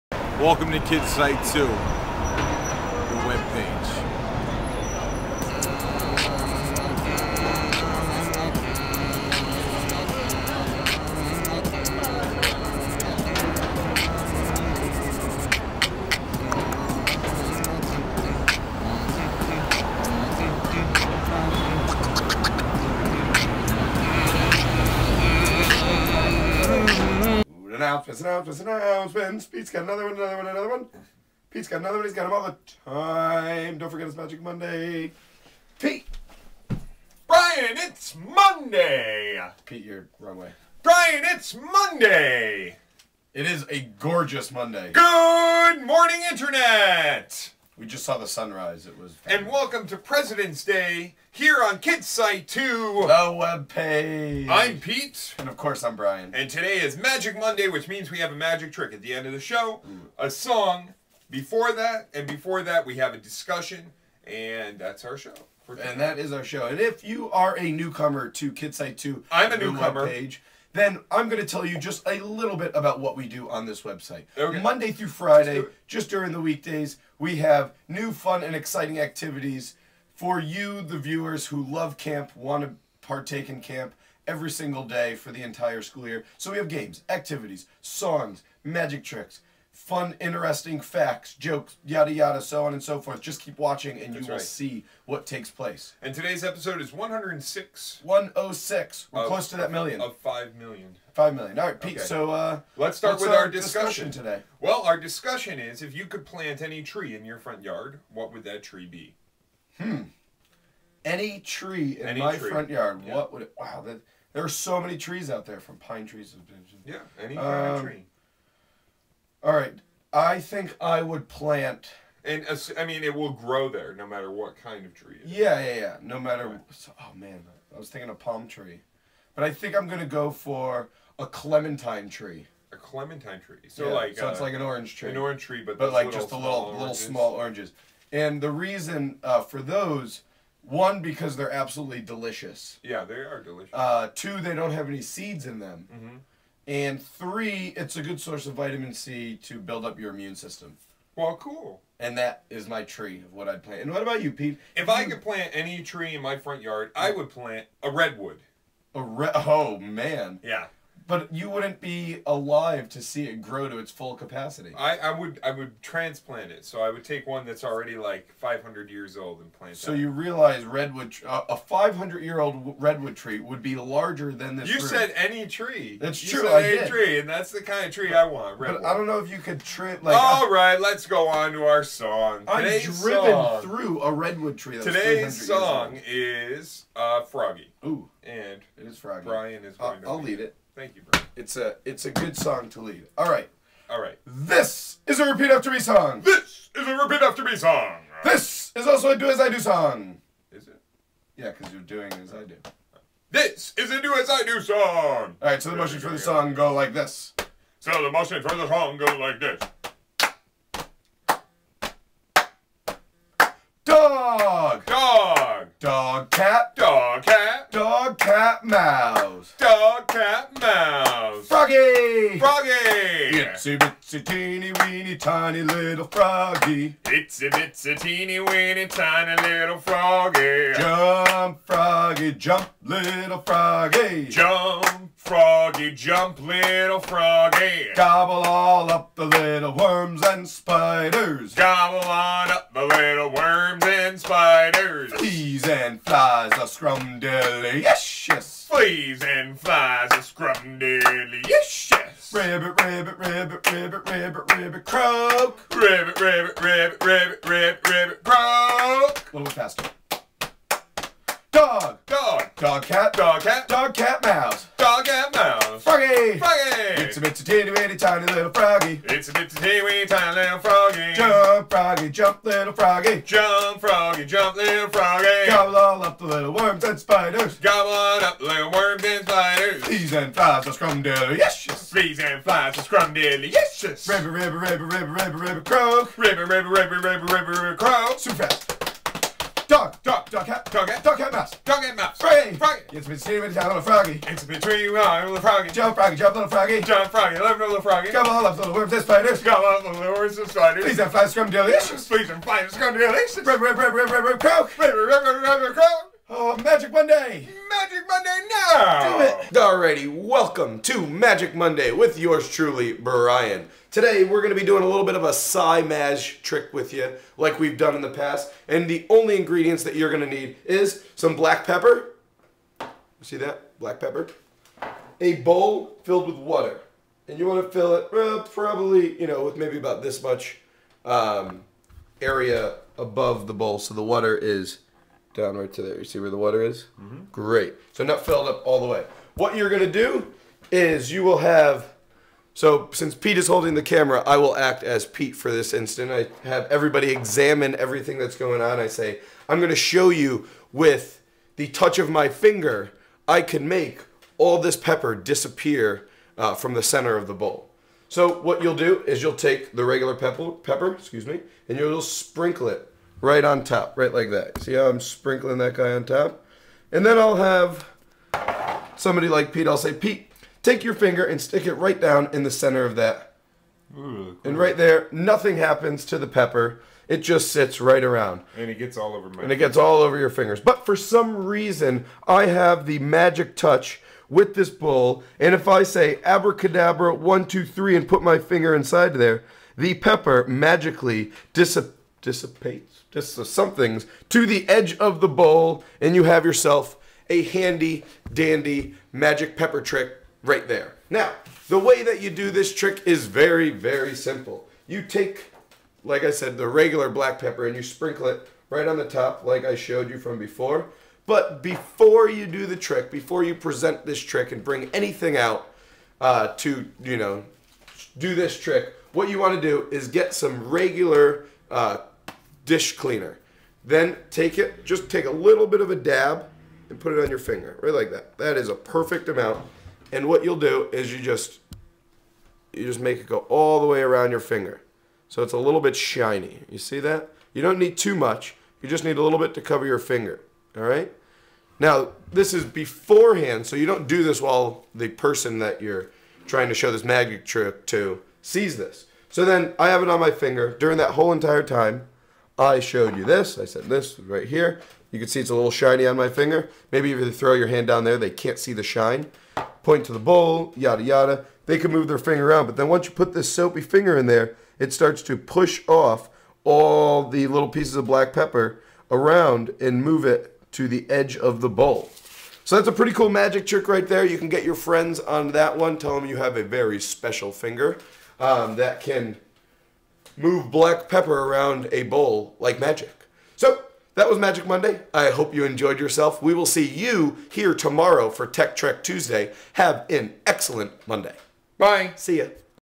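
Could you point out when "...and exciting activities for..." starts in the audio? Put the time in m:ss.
1:18.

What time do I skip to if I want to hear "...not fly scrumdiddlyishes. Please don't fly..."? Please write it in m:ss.
5:01.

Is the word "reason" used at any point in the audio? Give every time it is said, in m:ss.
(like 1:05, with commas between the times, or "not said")
2:18, 6:21.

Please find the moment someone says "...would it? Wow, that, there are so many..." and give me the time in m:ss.
1:53.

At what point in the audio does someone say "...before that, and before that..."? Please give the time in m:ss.
1:01.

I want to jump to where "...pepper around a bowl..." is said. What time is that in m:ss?
8:01.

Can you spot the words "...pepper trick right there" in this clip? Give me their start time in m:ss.
6:39.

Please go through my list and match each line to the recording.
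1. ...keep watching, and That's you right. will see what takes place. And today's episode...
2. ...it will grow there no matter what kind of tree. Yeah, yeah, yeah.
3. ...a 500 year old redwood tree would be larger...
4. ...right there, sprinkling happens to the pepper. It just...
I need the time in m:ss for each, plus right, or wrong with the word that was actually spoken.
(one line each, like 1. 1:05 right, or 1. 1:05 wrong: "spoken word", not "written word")
1. 1:33 right
2. 2:03 right
3. 2:51 right
4. 6:14 wrong: "nothing", not "sprinkling".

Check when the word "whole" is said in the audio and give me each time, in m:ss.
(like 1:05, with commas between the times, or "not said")
7:31.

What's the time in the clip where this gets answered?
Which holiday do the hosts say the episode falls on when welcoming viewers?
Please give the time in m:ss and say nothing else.
0:49.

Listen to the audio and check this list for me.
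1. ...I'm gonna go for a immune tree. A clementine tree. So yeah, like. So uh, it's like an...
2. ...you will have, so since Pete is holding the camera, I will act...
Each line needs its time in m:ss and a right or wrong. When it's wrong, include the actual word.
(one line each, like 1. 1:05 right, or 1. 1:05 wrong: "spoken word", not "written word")
1. 2:09 wrong: "clementine", not "immune"
2. 5:41 right.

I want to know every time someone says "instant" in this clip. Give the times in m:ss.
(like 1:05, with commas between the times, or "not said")
5:45.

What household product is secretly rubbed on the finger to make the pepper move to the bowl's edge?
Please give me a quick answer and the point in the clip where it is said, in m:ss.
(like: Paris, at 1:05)
Dish cleaner, at 7:02.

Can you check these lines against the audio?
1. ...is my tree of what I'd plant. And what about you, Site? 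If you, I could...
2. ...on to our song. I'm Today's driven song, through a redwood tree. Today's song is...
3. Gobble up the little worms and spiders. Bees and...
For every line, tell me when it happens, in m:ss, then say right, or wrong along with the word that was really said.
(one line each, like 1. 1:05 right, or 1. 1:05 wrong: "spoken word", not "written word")
1. 2:32 wrong: "Pete", not "Site"
2. 3:01 right
3. 4:37 right.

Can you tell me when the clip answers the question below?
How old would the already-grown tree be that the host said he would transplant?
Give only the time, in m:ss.
2:48.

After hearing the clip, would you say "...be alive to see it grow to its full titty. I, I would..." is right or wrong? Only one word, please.
wrong.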